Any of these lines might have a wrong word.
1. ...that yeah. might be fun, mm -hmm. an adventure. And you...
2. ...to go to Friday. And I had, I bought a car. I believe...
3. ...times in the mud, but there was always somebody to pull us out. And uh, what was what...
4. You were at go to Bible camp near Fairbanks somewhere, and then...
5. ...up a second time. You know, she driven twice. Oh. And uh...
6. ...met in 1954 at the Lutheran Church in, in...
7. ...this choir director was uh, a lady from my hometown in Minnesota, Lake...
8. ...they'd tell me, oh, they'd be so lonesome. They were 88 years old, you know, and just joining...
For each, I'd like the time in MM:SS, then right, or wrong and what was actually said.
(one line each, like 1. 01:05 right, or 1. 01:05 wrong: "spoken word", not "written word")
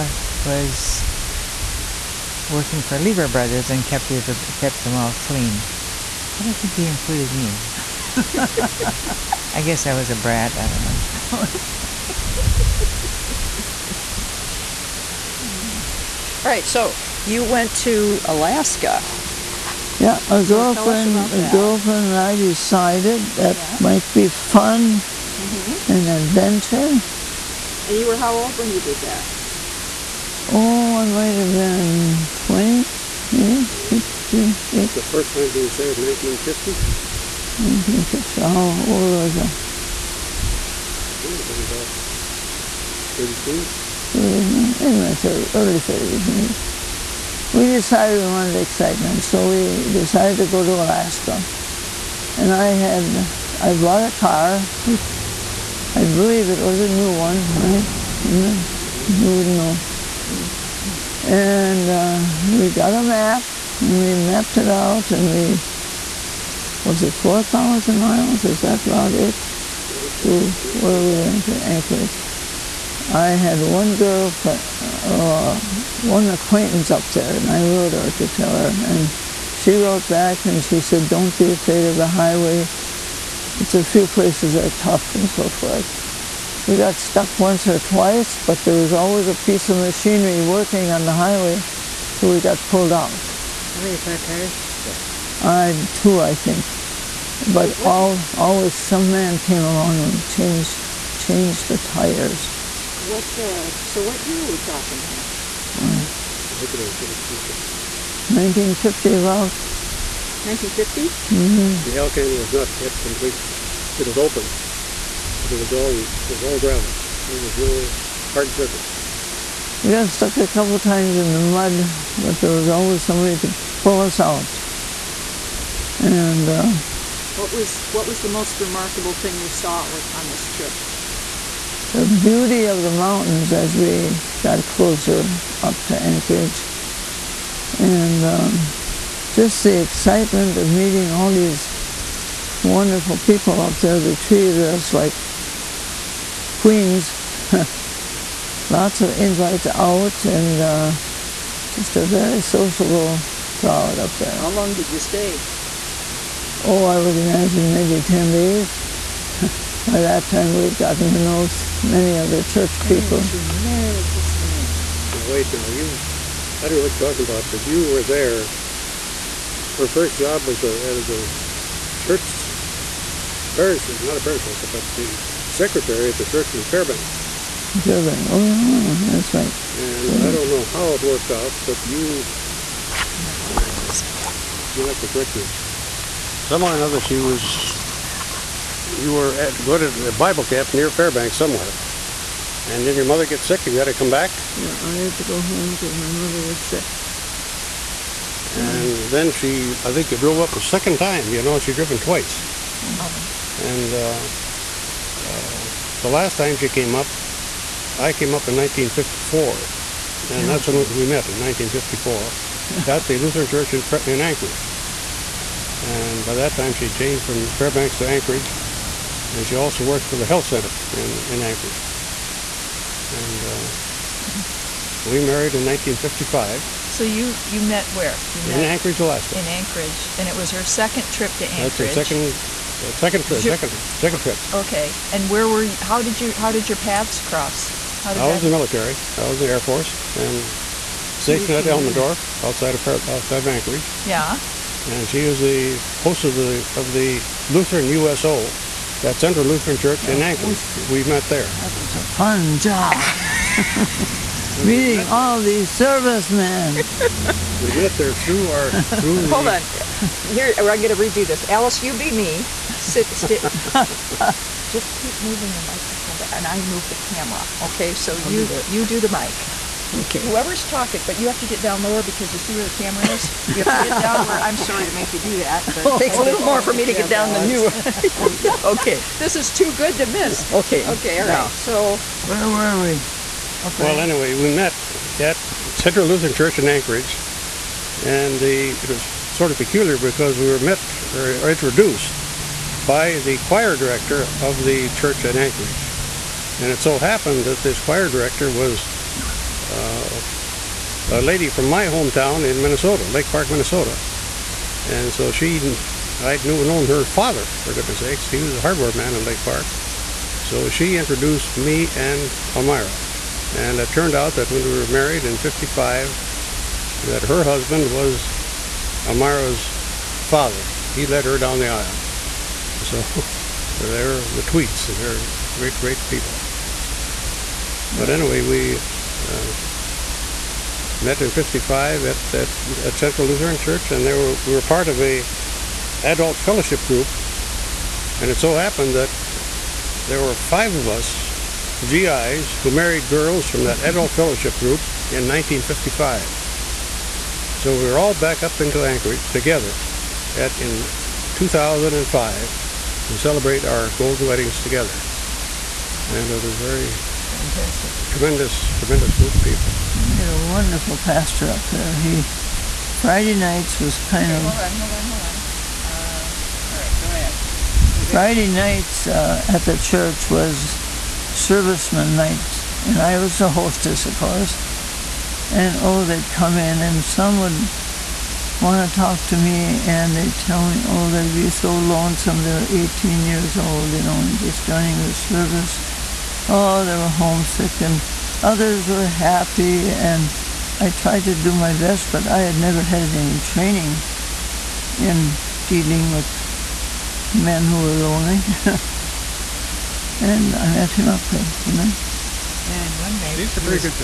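1. 00:23 right
2. 00:50 wrong: "Alaska", not "Friday"
3. 02:00 right
4. 03:08 right
5. 03:20 right
6. 03:31 right
7. 04:57 right
8. 06:20 wrong: "18", not "88".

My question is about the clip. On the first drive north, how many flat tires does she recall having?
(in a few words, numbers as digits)
2.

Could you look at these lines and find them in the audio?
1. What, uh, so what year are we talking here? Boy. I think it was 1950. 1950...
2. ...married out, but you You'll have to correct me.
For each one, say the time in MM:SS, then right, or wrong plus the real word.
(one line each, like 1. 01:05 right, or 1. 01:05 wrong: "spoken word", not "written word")
1. 01:43 right
2. 03:01 wrong: "worked", not "married".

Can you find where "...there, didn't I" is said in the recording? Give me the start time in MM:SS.
06:41.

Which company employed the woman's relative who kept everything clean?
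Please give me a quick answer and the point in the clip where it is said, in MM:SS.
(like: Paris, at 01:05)
Lever Brothers, at 00:02.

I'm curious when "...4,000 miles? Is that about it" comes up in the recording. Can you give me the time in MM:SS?
01:07.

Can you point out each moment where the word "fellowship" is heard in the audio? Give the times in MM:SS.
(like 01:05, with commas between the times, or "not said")
05:36, 05:44.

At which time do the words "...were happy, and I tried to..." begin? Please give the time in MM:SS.
06:28.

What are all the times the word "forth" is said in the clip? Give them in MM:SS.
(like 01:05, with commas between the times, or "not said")
01:25.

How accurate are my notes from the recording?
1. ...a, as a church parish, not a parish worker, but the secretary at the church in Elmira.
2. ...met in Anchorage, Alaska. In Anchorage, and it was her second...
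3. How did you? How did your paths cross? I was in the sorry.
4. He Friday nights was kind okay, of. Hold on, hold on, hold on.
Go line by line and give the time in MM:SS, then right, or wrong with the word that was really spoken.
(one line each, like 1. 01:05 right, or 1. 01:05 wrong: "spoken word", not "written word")
1. 02:50 wrong: "Fairbanks", not "Elmira"
2. 03:48 right
3. 03:55 wrong: "military", not "sorry"
4. 06:01 right.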